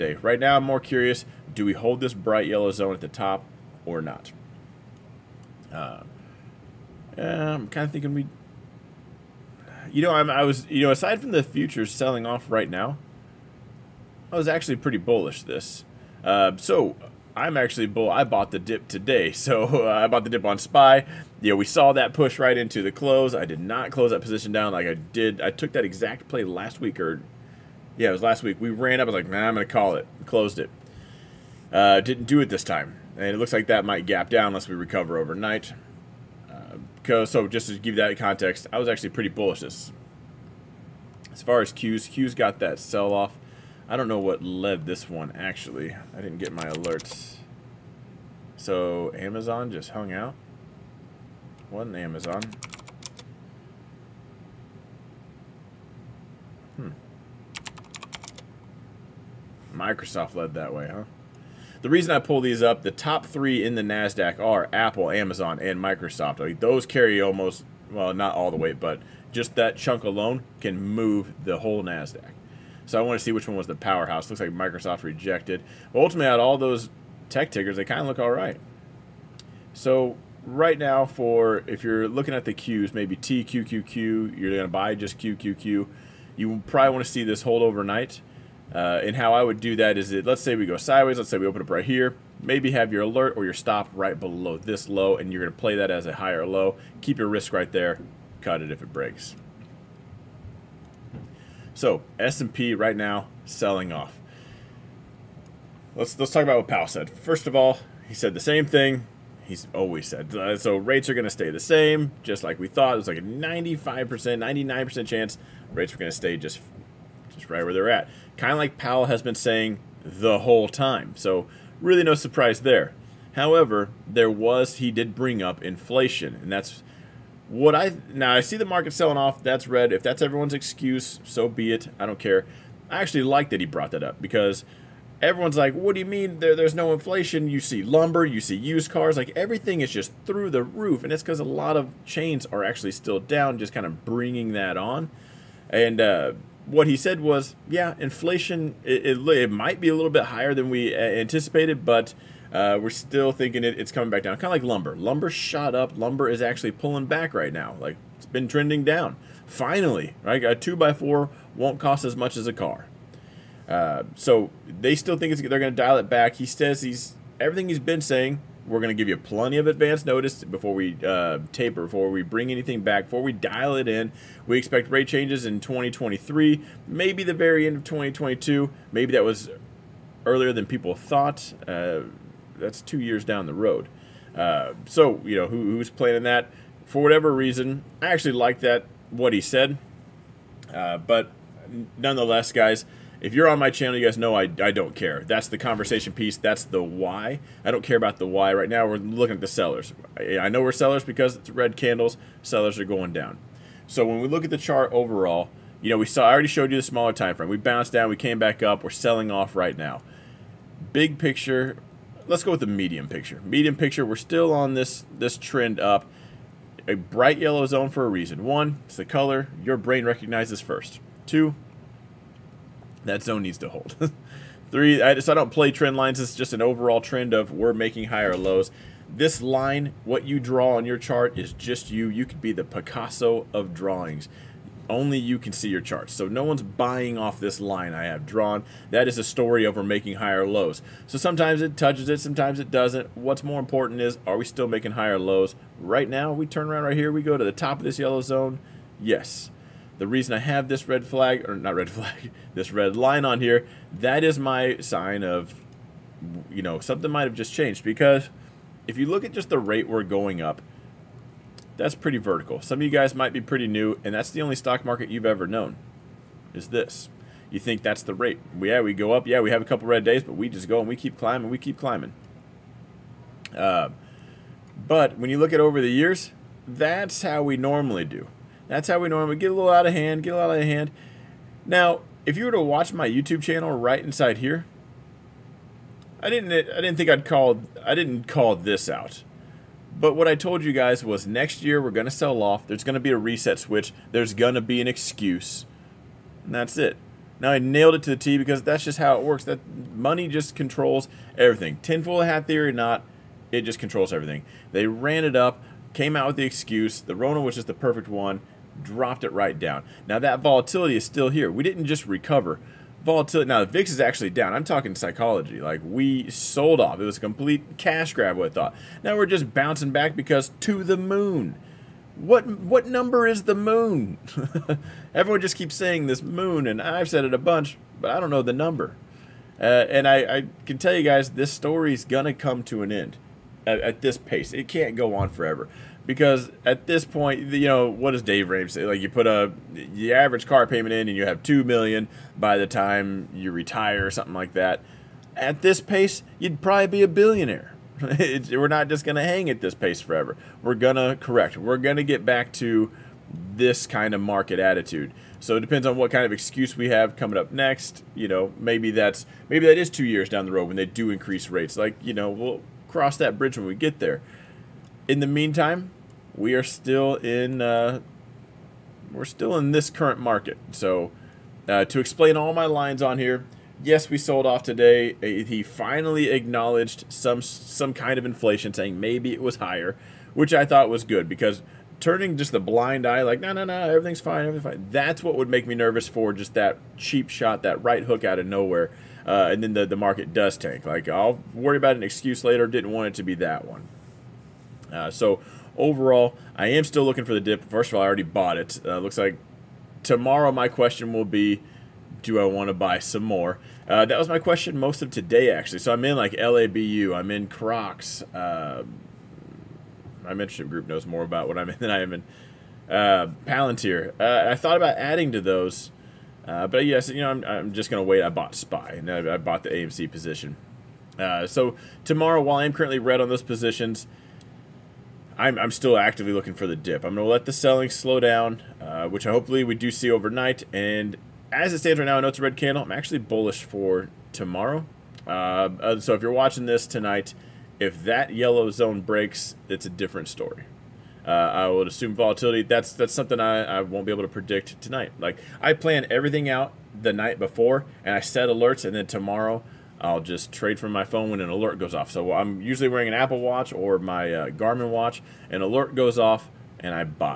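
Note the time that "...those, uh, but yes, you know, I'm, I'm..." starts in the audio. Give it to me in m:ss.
6:55.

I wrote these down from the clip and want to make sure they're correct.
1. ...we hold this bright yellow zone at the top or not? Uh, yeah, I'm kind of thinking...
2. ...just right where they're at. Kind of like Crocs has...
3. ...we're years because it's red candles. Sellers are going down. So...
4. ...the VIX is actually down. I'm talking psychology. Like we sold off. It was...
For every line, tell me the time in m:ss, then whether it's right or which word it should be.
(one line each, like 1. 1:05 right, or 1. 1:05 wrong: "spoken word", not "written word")
1. 0:01 right
2. 1:57 wrong: "Powell", not "Crocs"
3. 3:20 wrong: "sellers", not "years"
4. 5:13 right.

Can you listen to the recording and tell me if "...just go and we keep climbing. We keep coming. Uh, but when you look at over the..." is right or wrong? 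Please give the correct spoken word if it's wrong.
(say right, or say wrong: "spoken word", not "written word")
wrong: "climbing", not "coming".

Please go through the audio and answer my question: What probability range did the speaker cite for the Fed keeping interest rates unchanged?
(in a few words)
95%, 99%.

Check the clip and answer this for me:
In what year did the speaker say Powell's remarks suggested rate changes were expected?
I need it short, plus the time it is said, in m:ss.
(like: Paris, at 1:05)
2023, at 2:55.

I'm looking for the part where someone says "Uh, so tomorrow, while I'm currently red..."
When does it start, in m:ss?
7:01.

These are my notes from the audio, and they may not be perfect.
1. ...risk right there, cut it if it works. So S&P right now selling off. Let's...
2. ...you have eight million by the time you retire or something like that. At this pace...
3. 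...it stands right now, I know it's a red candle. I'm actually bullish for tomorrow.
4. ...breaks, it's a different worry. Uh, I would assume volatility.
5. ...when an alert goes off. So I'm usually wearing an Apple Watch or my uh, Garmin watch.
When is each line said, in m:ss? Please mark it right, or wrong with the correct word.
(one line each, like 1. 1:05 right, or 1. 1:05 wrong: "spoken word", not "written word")
1. 1:37 wrong: "breaks", not "works"
2. 5:41 wrong: "two", not "eight"
3. 7:11 right
4. 7:18 wrong: "story", not "worry"
5. 7:31 right.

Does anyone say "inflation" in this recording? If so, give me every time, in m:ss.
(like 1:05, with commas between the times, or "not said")
2:05, 2:16, 2:27, 6:18.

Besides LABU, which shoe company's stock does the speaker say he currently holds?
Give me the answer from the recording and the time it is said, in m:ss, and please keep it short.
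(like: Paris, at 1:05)
Crocs, at 6:47.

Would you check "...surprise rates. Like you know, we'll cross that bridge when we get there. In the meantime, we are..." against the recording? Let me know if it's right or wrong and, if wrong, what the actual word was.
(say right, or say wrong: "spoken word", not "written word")
wrong: "increase", not "surprise".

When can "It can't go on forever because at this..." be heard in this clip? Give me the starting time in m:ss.
5:34.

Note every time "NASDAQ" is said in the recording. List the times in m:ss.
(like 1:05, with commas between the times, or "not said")
1:03, 1:11.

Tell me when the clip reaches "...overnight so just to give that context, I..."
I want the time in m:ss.
0:35.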